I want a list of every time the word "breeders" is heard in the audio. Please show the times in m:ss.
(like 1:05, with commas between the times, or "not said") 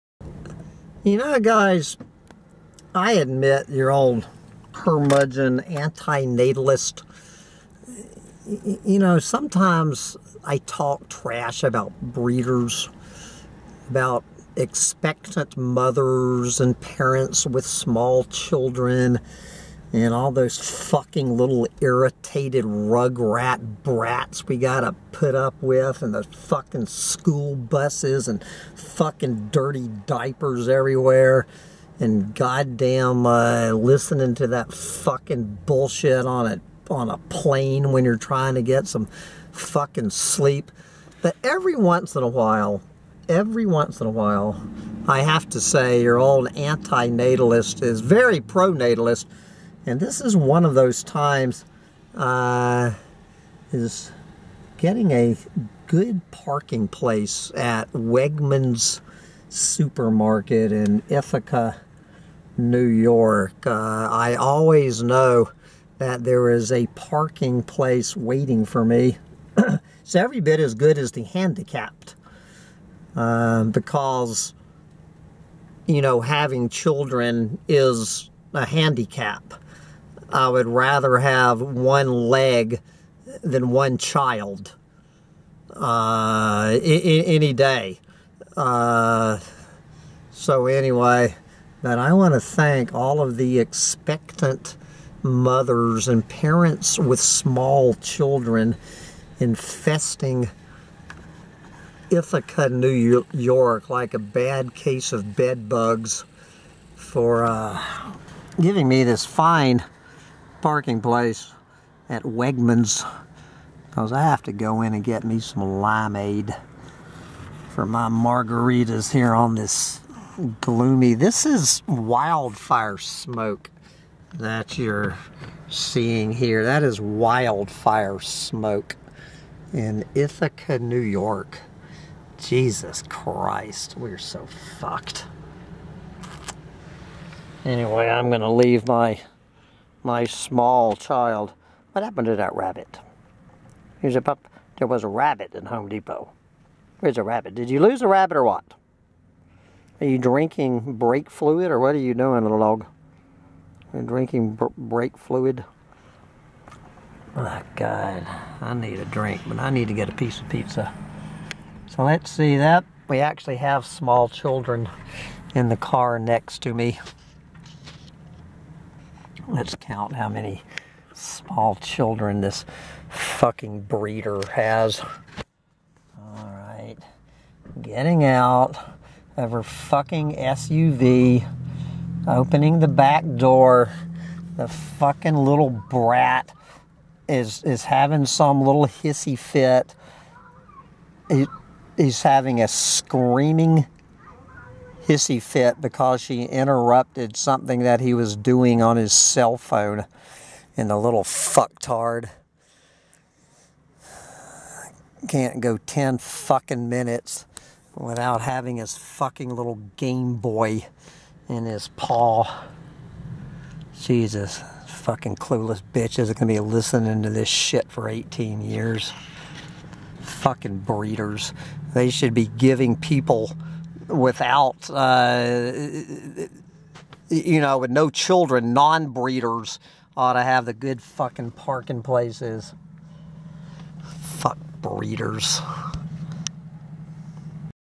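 0:12, 2:53, 3:40, 3:49, 3:54.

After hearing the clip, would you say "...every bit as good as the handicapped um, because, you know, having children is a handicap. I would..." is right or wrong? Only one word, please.
right.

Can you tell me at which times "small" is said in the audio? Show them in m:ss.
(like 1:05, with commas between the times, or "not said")
0:17, 1:37, 2:20, 2:43, 2:51.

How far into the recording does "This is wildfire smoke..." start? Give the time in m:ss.
2:01.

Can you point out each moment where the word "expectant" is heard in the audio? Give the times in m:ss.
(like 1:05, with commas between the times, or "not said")
0:14, 1:33.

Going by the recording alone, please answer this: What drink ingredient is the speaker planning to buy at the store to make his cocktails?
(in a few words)
limeade.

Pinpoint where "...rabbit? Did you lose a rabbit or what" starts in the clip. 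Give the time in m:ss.
2:27.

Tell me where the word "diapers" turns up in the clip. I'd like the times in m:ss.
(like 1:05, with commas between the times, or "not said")
0:30.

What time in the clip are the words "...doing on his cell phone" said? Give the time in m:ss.
3:18.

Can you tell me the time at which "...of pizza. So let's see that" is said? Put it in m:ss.
2:40.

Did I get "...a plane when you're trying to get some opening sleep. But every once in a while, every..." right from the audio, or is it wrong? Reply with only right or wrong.
wrong.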